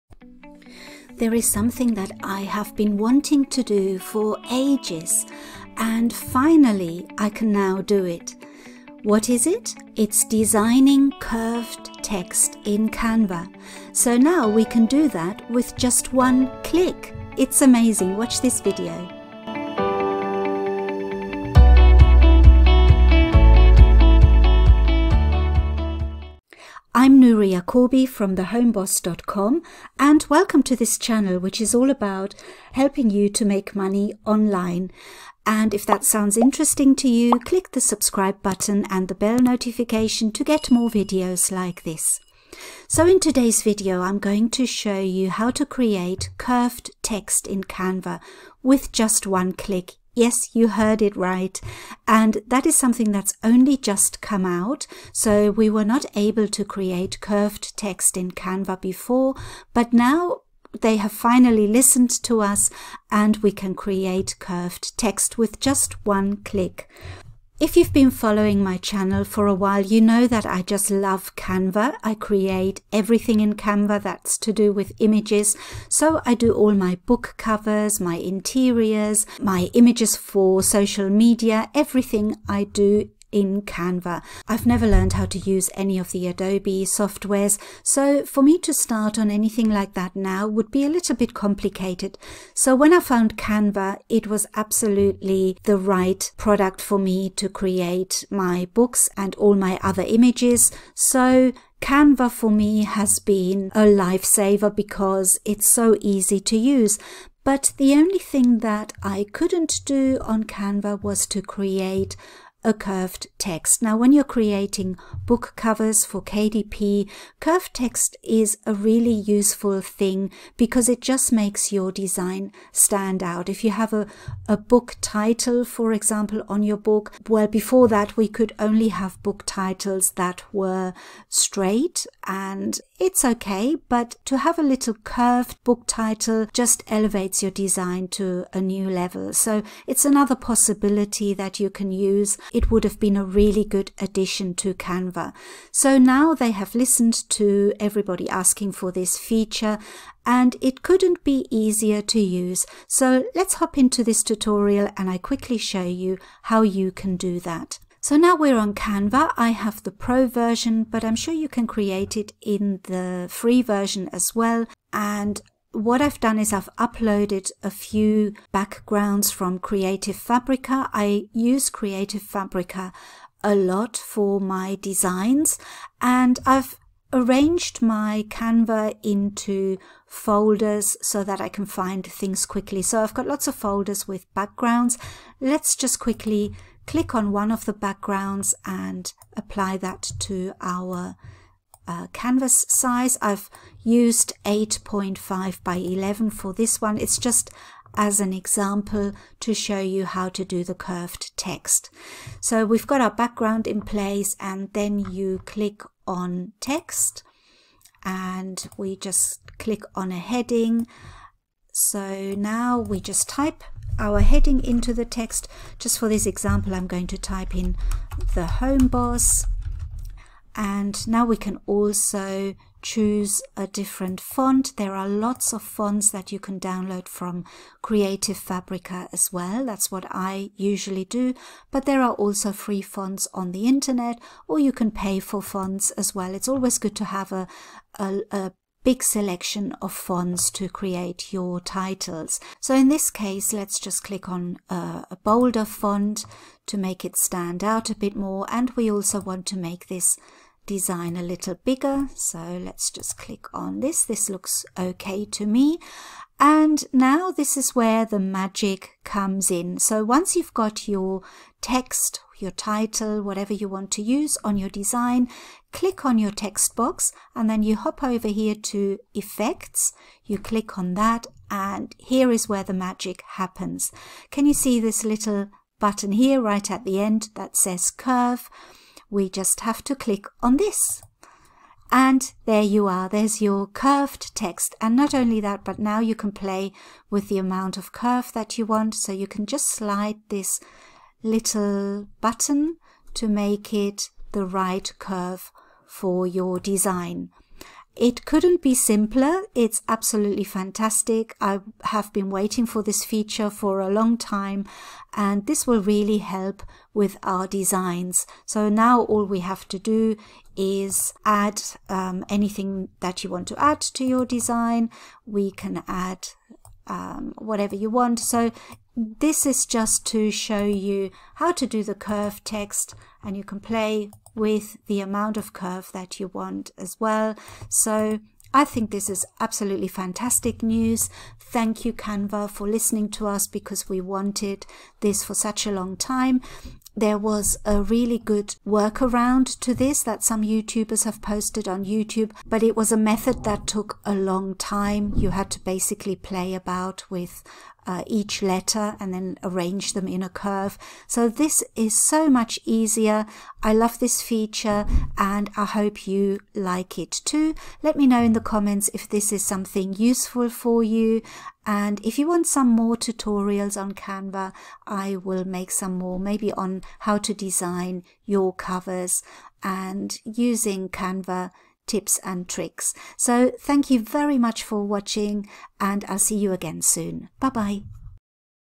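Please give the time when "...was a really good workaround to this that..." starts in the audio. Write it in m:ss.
5:37.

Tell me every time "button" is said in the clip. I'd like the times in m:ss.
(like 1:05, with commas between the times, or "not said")
0:38, 4:35, 4:52.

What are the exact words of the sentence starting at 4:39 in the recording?
We just have to click on this.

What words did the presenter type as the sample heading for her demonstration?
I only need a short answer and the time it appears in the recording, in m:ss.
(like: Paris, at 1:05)
the home boss, at 3:38.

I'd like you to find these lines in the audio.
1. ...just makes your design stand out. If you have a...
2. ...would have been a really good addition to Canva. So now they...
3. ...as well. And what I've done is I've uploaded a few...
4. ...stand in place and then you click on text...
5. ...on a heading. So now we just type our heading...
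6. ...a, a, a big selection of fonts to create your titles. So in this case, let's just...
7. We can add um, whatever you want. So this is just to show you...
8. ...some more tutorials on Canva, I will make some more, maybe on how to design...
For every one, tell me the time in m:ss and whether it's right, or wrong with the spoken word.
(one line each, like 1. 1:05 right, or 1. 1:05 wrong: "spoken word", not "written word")
1. 2:01 right
2. 2:22 right
3. 2:44 right
4. 3:23 wrong: "background", not "stand"
5. 3:29 right
6. 3:57 right
7. 5:15 right
8. 6:02 right.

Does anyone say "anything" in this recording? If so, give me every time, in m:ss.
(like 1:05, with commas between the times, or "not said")
1:29, 5:12.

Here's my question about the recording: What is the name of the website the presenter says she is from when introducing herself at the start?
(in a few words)
thehomeboss.com.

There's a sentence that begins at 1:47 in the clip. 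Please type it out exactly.
But the only thing that I couldn't do on Canva was to create a curved text.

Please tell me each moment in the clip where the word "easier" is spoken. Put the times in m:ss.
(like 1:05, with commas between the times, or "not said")
2:31, 5:52.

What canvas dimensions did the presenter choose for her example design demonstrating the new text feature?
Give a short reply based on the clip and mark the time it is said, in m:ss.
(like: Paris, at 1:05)
8.5 by 11, at 3:14.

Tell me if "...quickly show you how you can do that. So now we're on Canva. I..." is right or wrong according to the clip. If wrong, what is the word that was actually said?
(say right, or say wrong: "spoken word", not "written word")
right.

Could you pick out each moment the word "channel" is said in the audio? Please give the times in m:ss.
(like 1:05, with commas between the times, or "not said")
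0:30, 1:08.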